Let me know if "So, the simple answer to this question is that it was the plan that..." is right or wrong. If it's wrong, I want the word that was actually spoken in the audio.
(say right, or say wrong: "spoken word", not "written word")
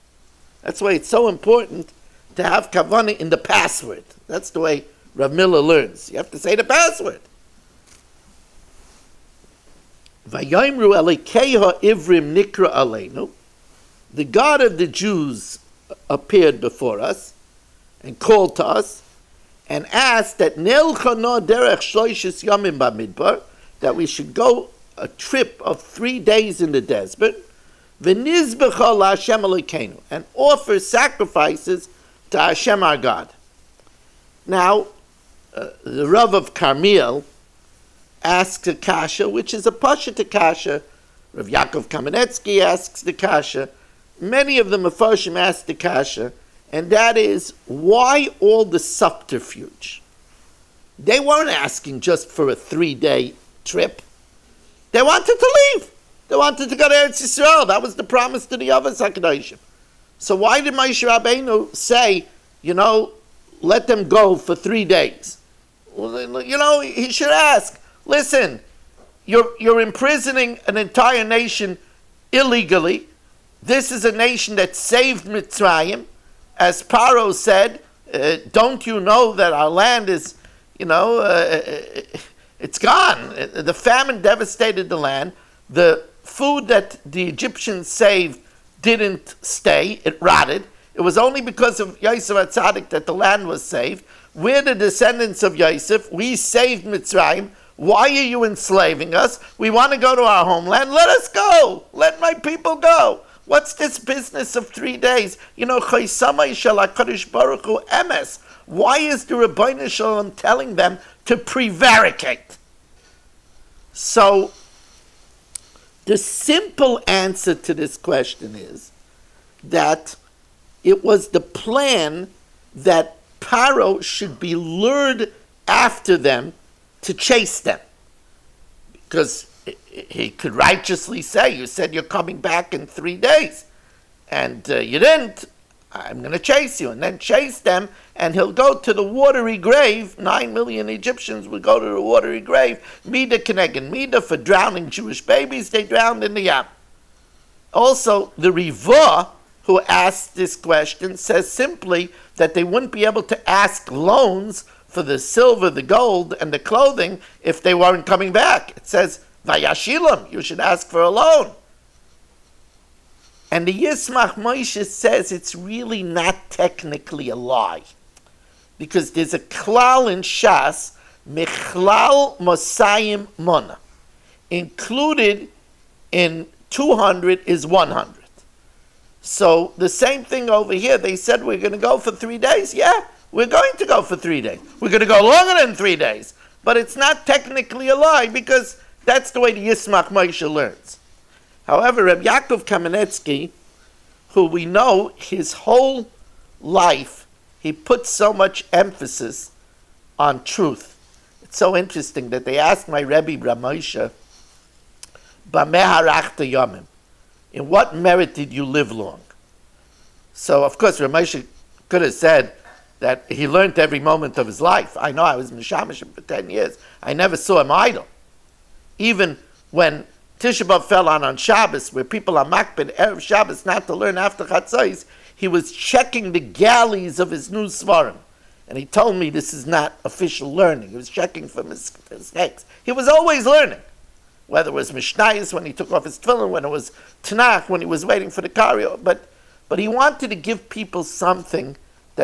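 right.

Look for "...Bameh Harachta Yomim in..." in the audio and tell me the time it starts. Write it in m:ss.
3:25.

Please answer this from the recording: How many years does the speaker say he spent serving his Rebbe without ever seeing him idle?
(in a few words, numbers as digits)
10.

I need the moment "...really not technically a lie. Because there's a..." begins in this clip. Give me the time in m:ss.
2:45.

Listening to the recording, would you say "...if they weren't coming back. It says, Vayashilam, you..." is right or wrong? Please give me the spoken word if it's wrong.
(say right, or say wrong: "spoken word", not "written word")
right.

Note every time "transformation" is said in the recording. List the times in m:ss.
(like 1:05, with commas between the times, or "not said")
not said.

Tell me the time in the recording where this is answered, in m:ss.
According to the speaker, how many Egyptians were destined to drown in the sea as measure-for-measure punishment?
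2:20.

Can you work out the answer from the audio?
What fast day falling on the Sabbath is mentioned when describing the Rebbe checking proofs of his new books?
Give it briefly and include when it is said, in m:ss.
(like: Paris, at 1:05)
Tisha B'Av, at 3:40.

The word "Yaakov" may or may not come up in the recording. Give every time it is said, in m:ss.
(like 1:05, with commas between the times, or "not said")
0:41, 3:12.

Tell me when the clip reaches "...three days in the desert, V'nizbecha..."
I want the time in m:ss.
0:25.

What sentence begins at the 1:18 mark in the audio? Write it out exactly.
Uh, don't you know that our land is, you know, uh, uh it's gone.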